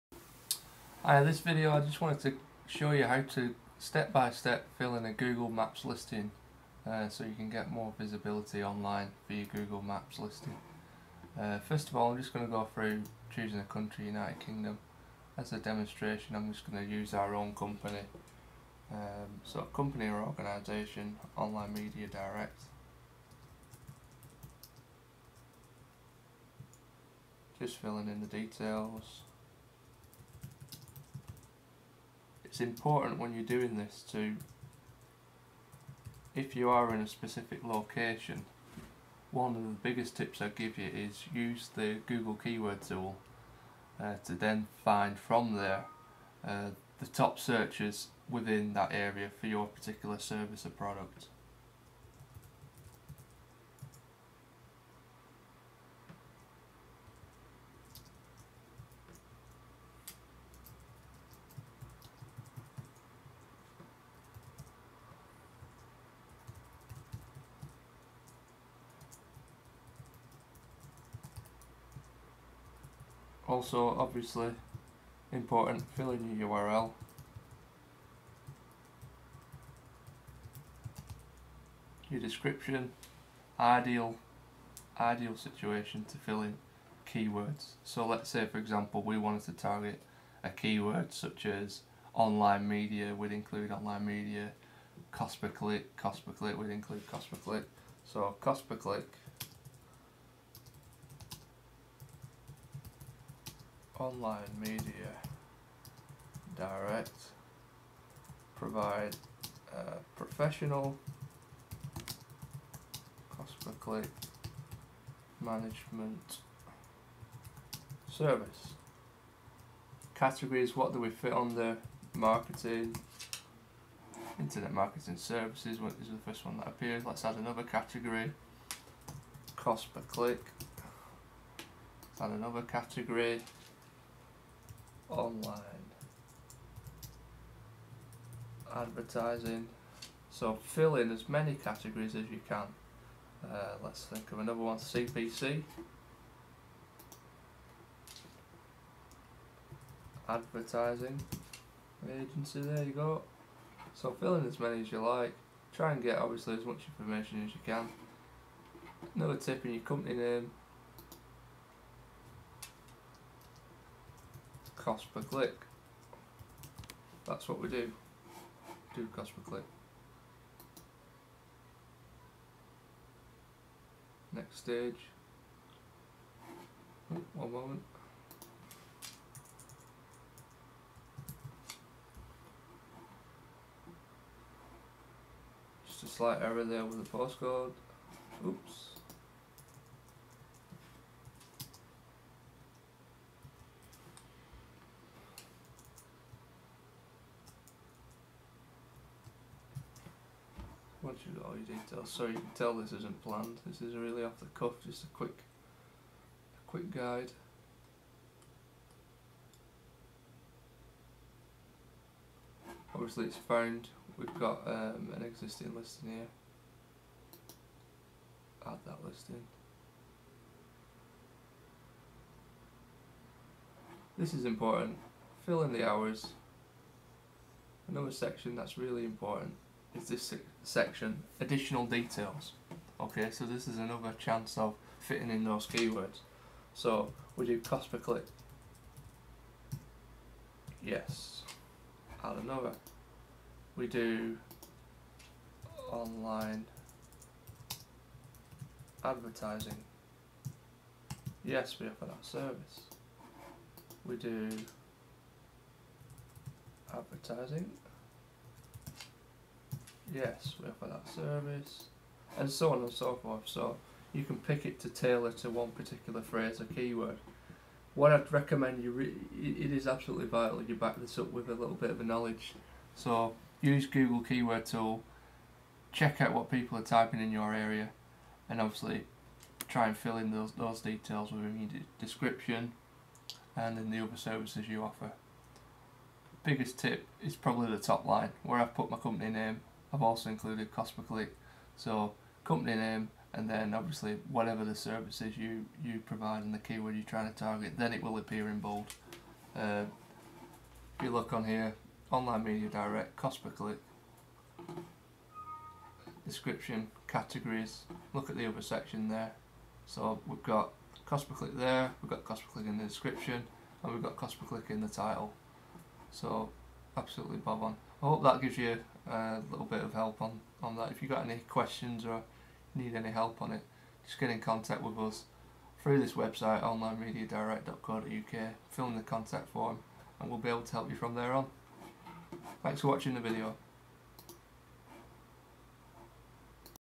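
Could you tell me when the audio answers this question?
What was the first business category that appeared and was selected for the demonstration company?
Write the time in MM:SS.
02:04.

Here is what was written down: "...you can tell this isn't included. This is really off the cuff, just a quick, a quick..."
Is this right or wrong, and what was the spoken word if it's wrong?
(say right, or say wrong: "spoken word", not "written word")
wrong: "planned", not "included".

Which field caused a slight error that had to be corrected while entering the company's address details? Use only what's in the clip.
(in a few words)
postcode.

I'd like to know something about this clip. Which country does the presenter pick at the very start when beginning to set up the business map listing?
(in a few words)
United Kingdom.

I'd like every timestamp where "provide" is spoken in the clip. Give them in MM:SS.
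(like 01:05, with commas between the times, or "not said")
01:48, 04:56.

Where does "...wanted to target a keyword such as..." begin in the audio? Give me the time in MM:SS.
01:29.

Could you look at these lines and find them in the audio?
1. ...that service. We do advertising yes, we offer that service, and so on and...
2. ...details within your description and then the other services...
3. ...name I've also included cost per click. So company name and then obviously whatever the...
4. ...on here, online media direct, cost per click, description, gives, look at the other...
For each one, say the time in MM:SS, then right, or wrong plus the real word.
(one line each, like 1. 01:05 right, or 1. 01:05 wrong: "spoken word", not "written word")
1. 04:12 right
2. 04:40 right
3. 04:49 right
4. 05:01 wrong: "categories", not "gives".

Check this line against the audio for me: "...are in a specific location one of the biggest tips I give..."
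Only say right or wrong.
right.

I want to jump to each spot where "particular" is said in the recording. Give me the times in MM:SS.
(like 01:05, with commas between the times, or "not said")
00:49, 04:25.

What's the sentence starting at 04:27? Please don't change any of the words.
What I'd recommend you, re it is absolutely vital you back this up with a little bit of a knowledge.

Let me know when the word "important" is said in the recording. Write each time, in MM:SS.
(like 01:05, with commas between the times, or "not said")
00:32, 01:15, 03:44, 03:49.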